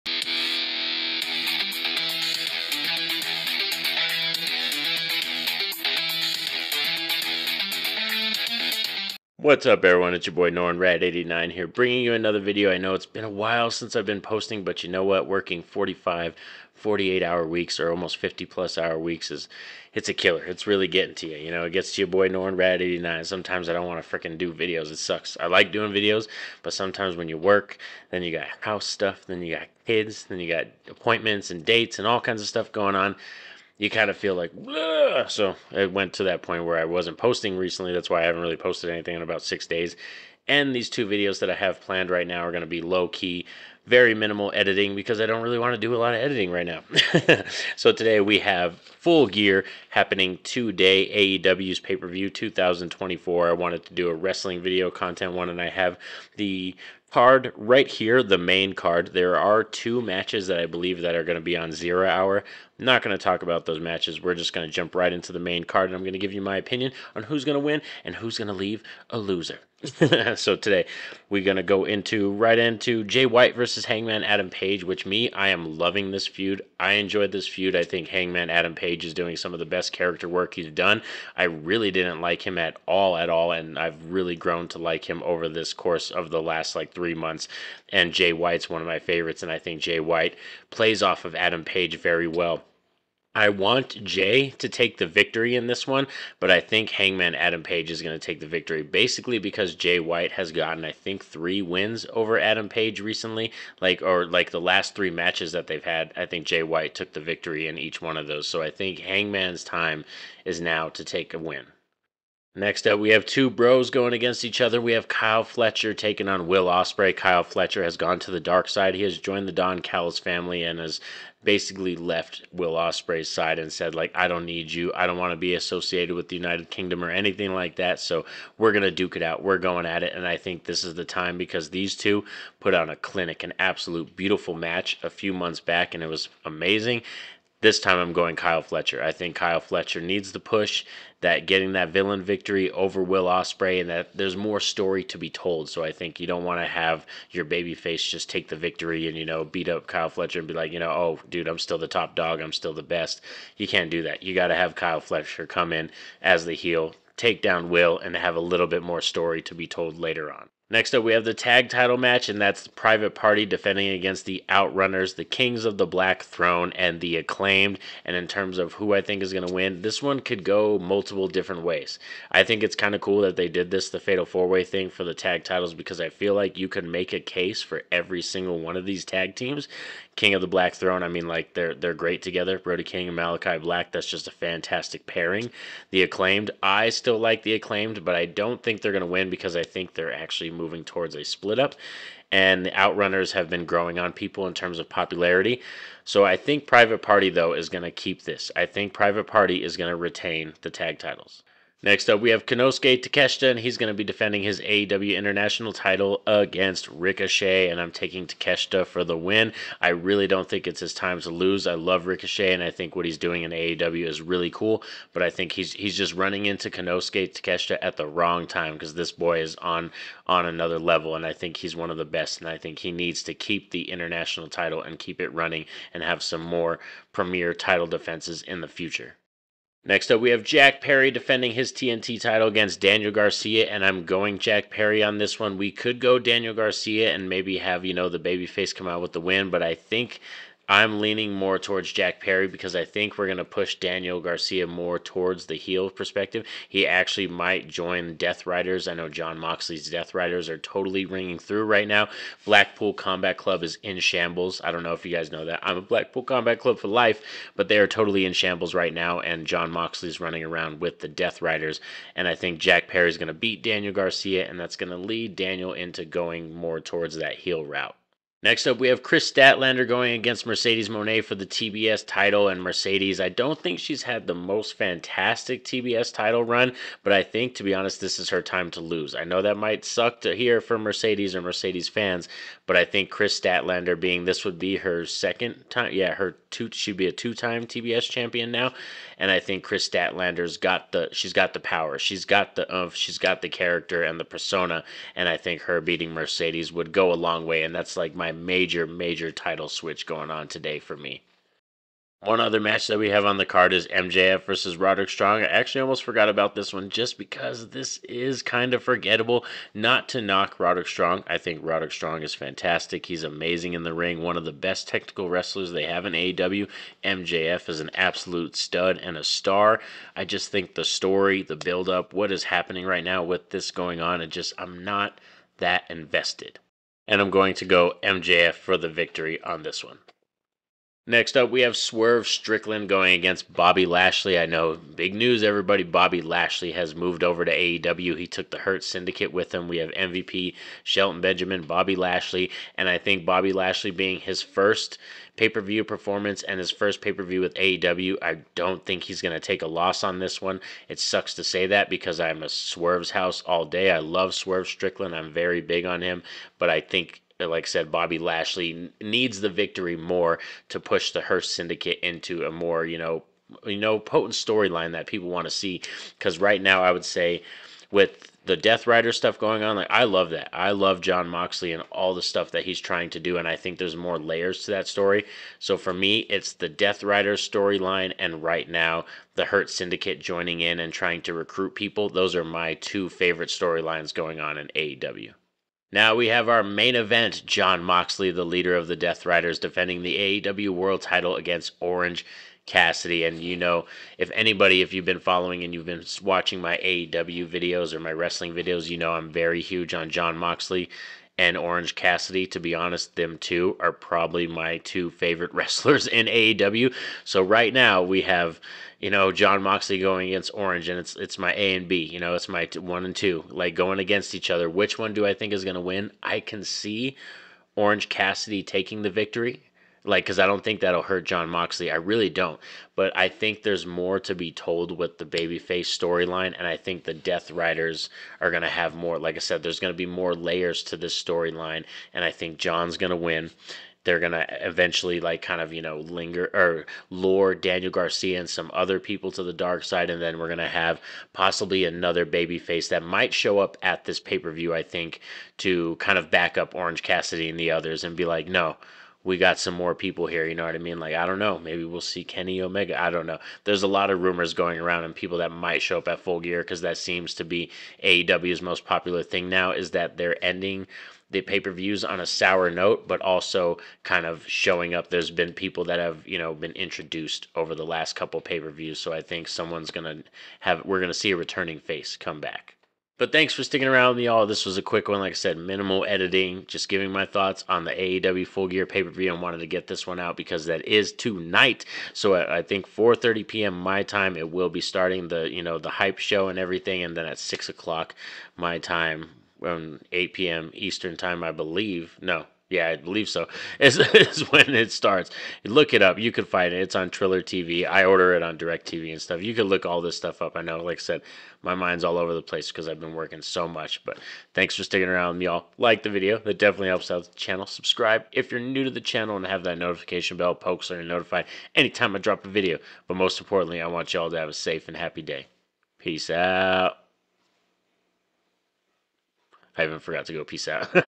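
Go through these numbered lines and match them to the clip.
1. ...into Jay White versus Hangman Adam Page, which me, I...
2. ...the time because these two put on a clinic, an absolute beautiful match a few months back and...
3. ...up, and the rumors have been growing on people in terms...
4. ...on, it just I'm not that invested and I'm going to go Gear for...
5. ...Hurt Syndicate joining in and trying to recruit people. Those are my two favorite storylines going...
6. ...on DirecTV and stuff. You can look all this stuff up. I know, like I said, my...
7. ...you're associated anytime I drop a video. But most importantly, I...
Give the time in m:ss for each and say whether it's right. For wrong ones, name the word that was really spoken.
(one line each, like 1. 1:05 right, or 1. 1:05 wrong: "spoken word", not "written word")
1. 1:12 right
2. 2:10 right
3. 3:11 wrong: "outrunners", not "rumors"
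4. 5:23 wrong: "MJF", not "Gear"
5. 6:19 right
6. 8:18 right
7. 8:30 wrong: "notified", not "associated".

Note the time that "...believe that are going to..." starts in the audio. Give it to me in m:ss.
1:00.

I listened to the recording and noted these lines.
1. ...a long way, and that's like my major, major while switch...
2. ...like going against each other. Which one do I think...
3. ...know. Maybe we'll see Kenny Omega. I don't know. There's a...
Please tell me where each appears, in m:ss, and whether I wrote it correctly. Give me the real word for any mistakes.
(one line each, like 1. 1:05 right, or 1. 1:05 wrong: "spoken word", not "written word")
1. 4:57 wrong: "title", not "while"
2. 6:53 right
3. 7:31 right.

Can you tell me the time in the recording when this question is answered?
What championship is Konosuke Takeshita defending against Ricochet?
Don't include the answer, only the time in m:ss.
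3:24.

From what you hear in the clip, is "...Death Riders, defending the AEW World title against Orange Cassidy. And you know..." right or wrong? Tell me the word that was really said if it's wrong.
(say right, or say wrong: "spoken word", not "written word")
right.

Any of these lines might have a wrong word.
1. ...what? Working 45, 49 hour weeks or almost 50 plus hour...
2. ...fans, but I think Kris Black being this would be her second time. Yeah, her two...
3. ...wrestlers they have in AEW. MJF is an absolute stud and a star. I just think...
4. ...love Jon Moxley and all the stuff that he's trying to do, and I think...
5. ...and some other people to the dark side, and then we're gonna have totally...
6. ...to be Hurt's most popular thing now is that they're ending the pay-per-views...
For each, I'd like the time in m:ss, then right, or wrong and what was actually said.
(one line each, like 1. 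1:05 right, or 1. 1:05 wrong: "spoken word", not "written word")
1. 0:15 wrong: "48", not "49"
2. 4:41 wrong: "Statlander", not "Black"
3. 5:15 right
4. 6:10 right
5. 7:18 wrong: "possibly", not "totally"
6. 7:37 wrong: "AEW", not "Hurt".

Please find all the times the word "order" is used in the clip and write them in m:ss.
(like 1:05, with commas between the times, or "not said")
8:18.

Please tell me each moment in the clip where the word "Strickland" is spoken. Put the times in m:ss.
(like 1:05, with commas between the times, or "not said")
5:32, 5:54.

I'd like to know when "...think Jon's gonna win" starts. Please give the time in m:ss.
7:12.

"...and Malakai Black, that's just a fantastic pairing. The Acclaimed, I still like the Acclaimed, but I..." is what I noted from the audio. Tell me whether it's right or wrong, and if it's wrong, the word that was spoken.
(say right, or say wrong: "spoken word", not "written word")
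right.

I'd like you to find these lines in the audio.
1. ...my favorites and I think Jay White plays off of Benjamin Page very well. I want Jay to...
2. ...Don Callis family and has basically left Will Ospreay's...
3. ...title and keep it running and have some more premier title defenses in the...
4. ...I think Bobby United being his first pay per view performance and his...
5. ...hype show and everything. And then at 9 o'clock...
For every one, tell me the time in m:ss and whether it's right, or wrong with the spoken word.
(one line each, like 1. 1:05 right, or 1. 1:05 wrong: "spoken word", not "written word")
1. 1:28 wrong: "Adam", not "Benjamin"
2. 1:59 right
3. 3:44 right
4. 5:42 wrong: "Lashley", not "United"
5. 8:05 wrong: "6", not "9".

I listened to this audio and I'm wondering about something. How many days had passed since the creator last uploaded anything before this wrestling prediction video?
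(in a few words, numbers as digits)
6.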